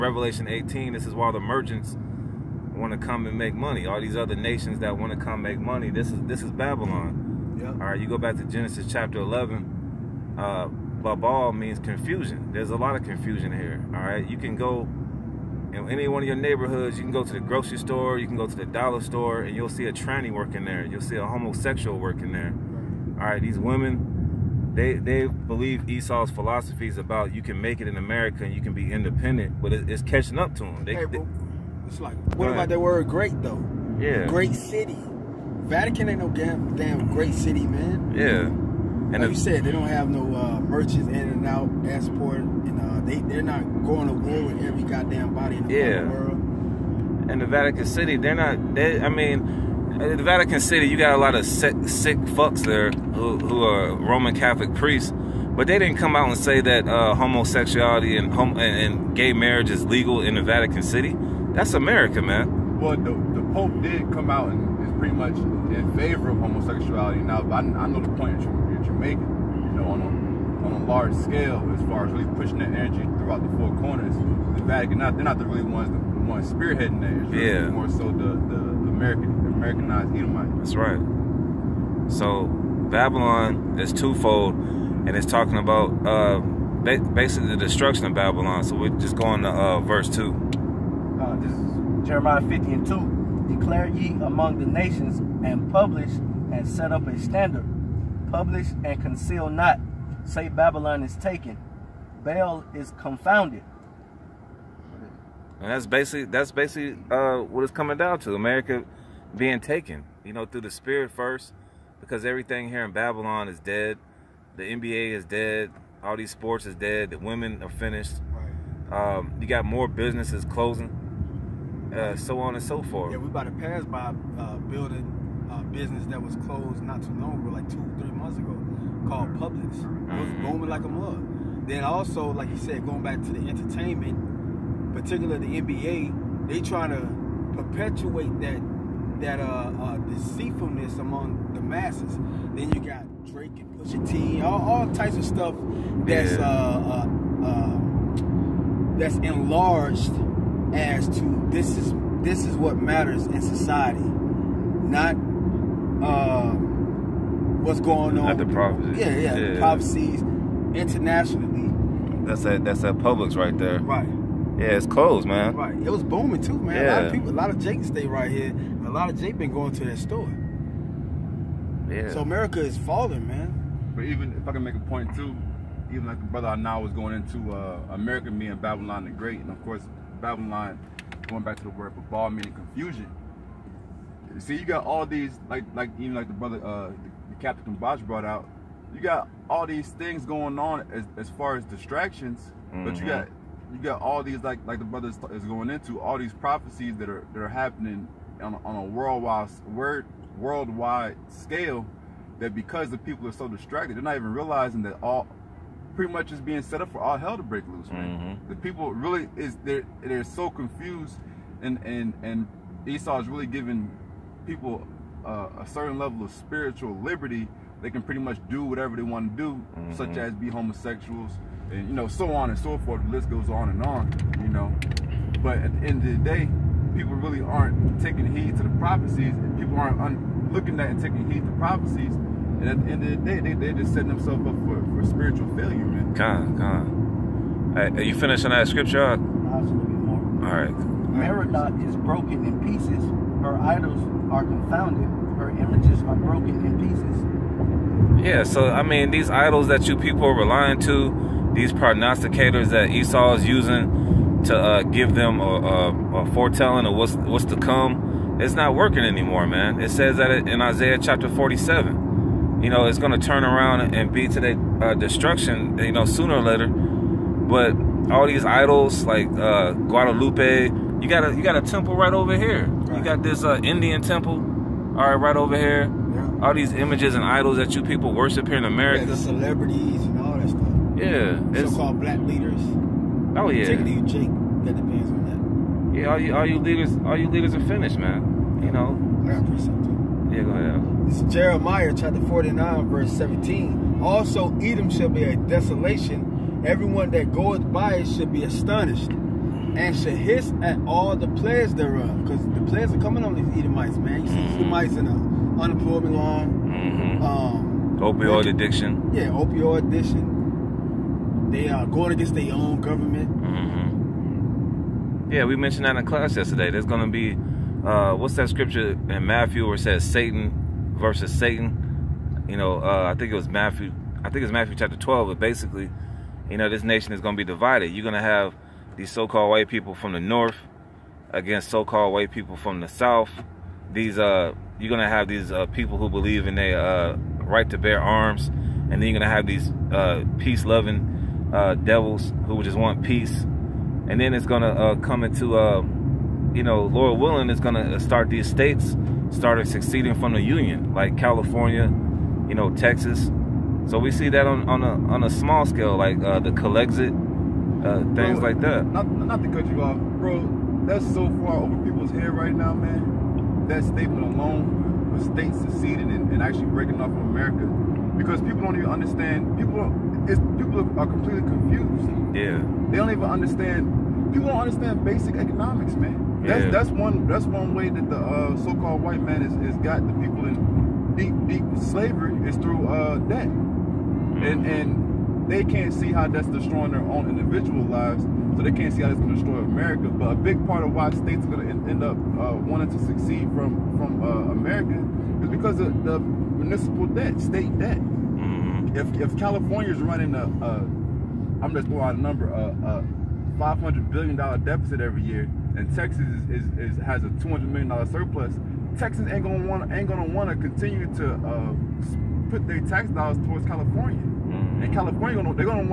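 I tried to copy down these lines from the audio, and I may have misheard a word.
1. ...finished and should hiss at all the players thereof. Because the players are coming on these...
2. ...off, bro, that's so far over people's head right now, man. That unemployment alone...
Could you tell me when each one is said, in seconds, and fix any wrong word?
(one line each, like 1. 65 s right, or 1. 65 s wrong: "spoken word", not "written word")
1. 298 s wrong: "astonished", not "finished"
2. 359 s wrong: "statement", not "unemployment".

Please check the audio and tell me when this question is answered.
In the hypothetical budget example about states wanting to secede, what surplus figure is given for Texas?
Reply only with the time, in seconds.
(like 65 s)
407 s.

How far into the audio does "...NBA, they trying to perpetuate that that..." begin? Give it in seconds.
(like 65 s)
135 s.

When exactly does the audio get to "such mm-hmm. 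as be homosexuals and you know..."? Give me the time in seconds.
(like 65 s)
219 s.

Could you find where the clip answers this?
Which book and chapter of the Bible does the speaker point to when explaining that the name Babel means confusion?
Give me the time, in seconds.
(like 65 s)
8 s.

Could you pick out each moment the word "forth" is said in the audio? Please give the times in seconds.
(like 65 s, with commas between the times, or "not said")
122 s, 222 s.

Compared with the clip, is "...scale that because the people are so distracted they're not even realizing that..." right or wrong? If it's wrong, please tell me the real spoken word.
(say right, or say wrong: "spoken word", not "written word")
right.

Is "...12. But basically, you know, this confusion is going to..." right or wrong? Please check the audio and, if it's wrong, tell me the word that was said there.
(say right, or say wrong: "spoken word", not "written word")
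wrong: "nation", not "confusion".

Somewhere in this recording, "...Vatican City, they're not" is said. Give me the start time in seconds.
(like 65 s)
47 s.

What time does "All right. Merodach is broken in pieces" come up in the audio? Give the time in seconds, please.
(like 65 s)
239 s.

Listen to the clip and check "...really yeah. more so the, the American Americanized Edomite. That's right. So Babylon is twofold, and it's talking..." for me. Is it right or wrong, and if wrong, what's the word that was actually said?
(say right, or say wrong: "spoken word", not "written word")
right.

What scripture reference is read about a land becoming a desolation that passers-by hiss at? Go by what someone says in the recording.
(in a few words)
Jeremiah 49:17.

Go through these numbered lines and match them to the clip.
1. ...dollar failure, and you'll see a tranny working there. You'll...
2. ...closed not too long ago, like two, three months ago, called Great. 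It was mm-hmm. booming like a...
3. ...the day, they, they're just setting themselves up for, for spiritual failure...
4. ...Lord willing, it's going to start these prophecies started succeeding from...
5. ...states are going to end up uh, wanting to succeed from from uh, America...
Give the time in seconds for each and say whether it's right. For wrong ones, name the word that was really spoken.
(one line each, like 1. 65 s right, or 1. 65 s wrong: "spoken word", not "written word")
1. 18 s wrong: "store", not "failure"
2. 126 s wrong: "Publix", not "Great"
3. 233 s right
4. 346 s wrong: "states", not "prophecies"
5. 391 s right.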